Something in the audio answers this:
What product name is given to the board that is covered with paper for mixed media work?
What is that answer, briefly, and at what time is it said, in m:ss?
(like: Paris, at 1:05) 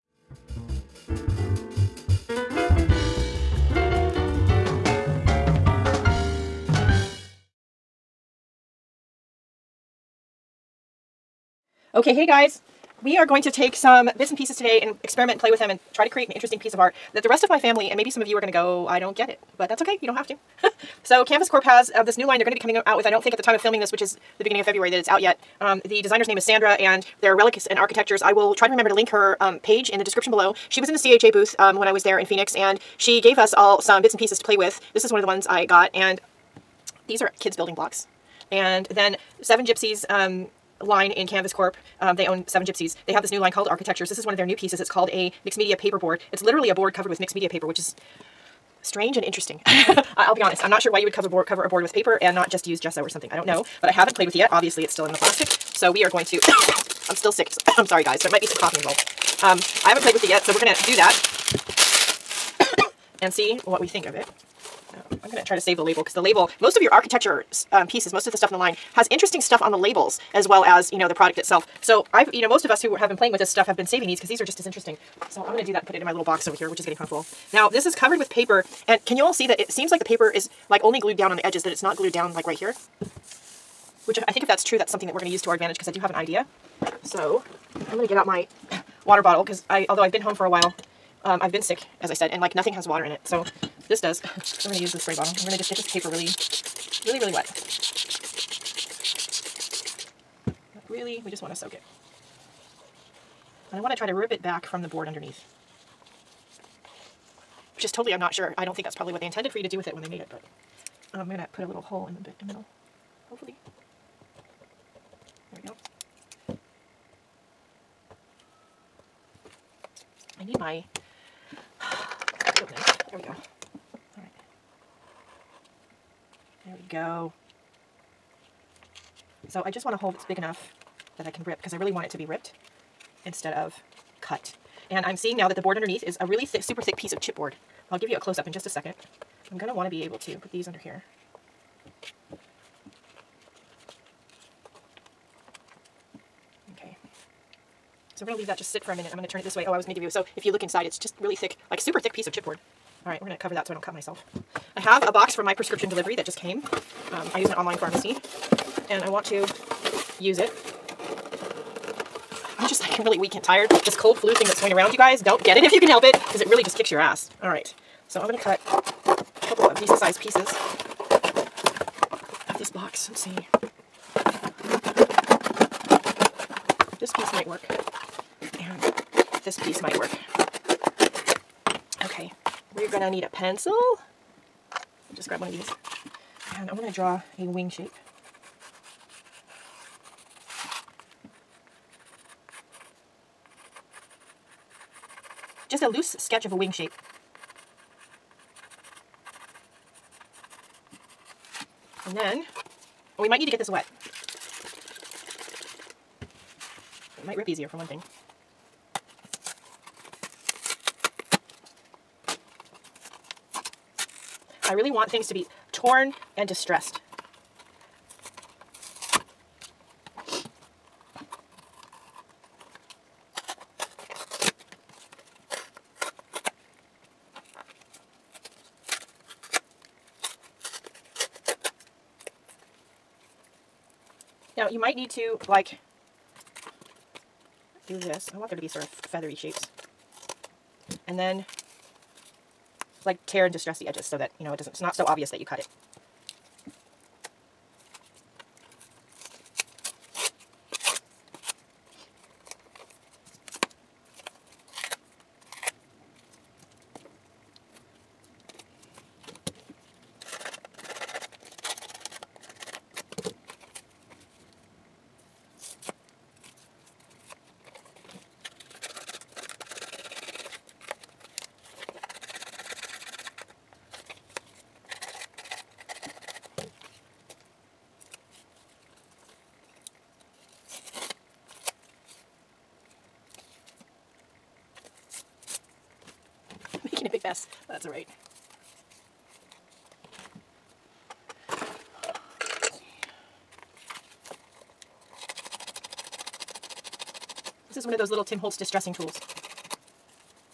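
mixed media paper board, at 0:45.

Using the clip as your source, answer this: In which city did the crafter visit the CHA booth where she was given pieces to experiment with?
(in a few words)
Phoenix.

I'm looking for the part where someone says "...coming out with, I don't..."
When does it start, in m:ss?
0:22.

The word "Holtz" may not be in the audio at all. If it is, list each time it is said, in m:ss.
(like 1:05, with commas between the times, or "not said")
4:58.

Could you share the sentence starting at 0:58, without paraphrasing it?
There might be some coughing involved.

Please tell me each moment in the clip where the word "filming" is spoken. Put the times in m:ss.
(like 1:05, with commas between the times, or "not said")
0:23.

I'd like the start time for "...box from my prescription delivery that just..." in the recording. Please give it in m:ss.
2:35.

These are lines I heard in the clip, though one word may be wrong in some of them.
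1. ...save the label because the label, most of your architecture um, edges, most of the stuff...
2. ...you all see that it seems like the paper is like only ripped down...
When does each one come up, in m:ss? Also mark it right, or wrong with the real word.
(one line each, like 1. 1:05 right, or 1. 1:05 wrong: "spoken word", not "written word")
1. 1:05 wrong: "pieces", not "edges"
2. 1:19 wrong: "glued", not "ripped".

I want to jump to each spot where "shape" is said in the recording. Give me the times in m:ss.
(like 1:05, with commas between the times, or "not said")
3:07, 3:16, 3:59.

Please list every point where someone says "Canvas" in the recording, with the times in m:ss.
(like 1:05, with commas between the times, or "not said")
0:21, 0:41.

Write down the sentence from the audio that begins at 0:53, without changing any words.
I don't know, but I haven't played with it yet.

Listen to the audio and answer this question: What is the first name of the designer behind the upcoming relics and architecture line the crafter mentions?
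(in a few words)
Sandra.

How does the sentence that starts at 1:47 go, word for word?
Which is totally, I'm not sure.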